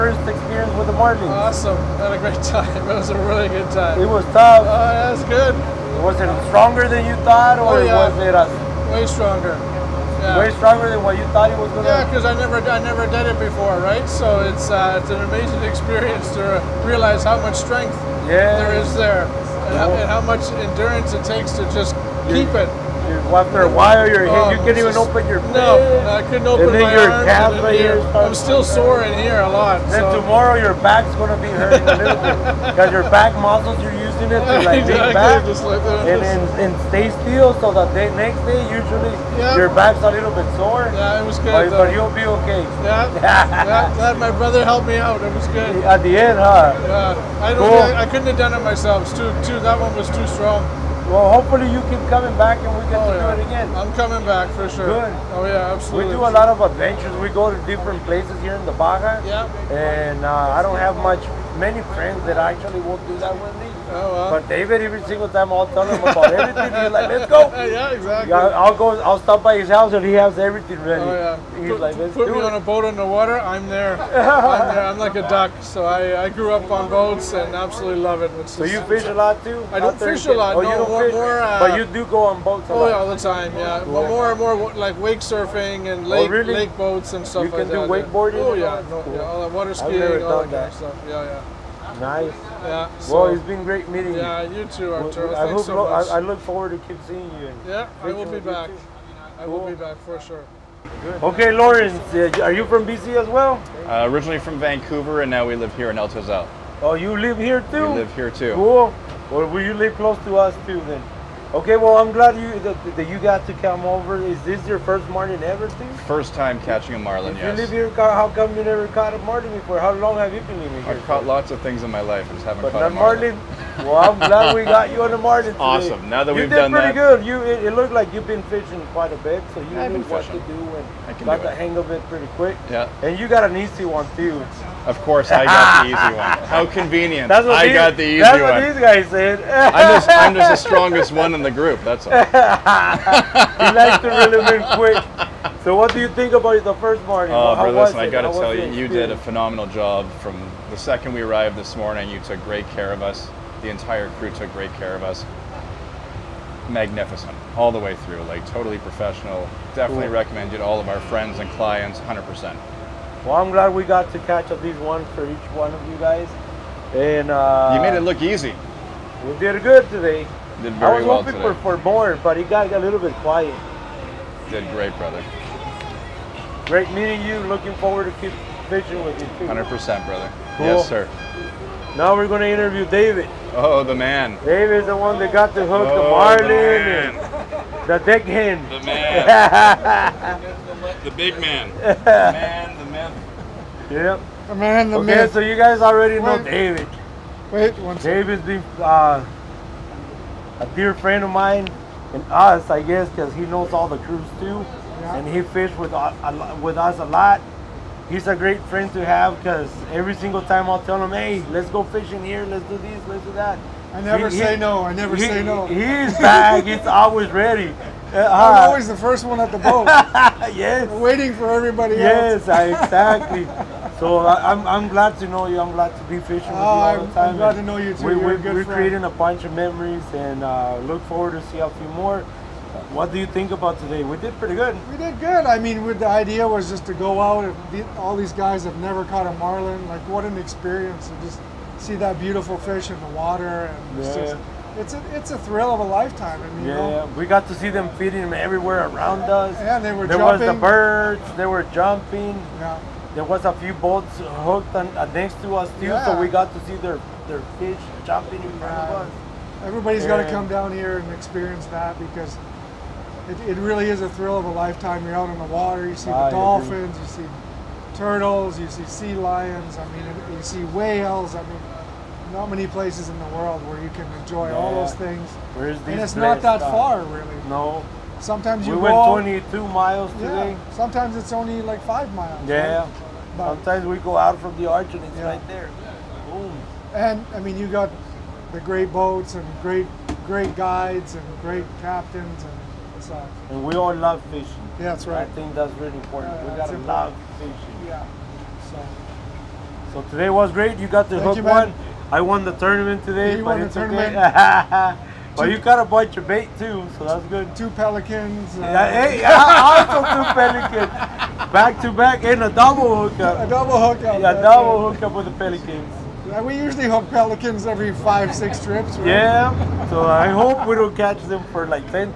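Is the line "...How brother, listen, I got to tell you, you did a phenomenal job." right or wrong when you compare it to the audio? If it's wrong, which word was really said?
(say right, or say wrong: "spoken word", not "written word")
right.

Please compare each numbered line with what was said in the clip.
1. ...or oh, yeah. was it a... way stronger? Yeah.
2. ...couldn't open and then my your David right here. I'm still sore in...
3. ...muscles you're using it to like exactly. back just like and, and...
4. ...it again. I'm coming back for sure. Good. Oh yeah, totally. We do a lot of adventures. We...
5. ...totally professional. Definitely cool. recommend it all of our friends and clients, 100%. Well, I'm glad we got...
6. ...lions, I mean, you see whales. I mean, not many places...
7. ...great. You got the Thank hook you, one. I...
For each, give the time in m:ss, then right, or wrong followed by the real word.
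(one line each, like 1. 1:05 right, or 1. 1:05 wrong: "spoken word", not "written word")
1. 0:07 right
2. 0:26 wrong: "Calf", not "David"
3. 0:33 right
4. 0:53 wrong: "absolutely", not "totally"
5. 2:38 right
6. 4:29 right
7. 5:00 right.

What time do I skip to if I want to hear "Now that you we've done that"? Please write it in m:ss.
2:06.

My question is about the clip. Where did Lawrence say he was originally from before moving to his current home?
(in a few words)
Vancouver.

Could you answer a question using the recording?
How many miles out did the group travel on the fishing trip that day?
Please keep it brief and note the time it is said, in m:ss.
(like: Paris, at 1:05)
22, at 4:39.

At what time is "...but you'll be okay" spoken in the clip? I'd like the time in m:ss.
0:41.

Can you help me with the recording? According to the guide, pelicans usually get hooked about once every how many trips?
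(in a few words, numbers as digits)
5 or 6.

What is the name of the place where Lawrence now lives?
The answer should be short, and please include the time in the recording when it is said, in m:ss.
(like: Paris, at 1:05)
El Tezal, at 1:45.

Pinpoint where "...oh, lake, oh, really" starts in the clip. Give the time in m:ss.
1:26.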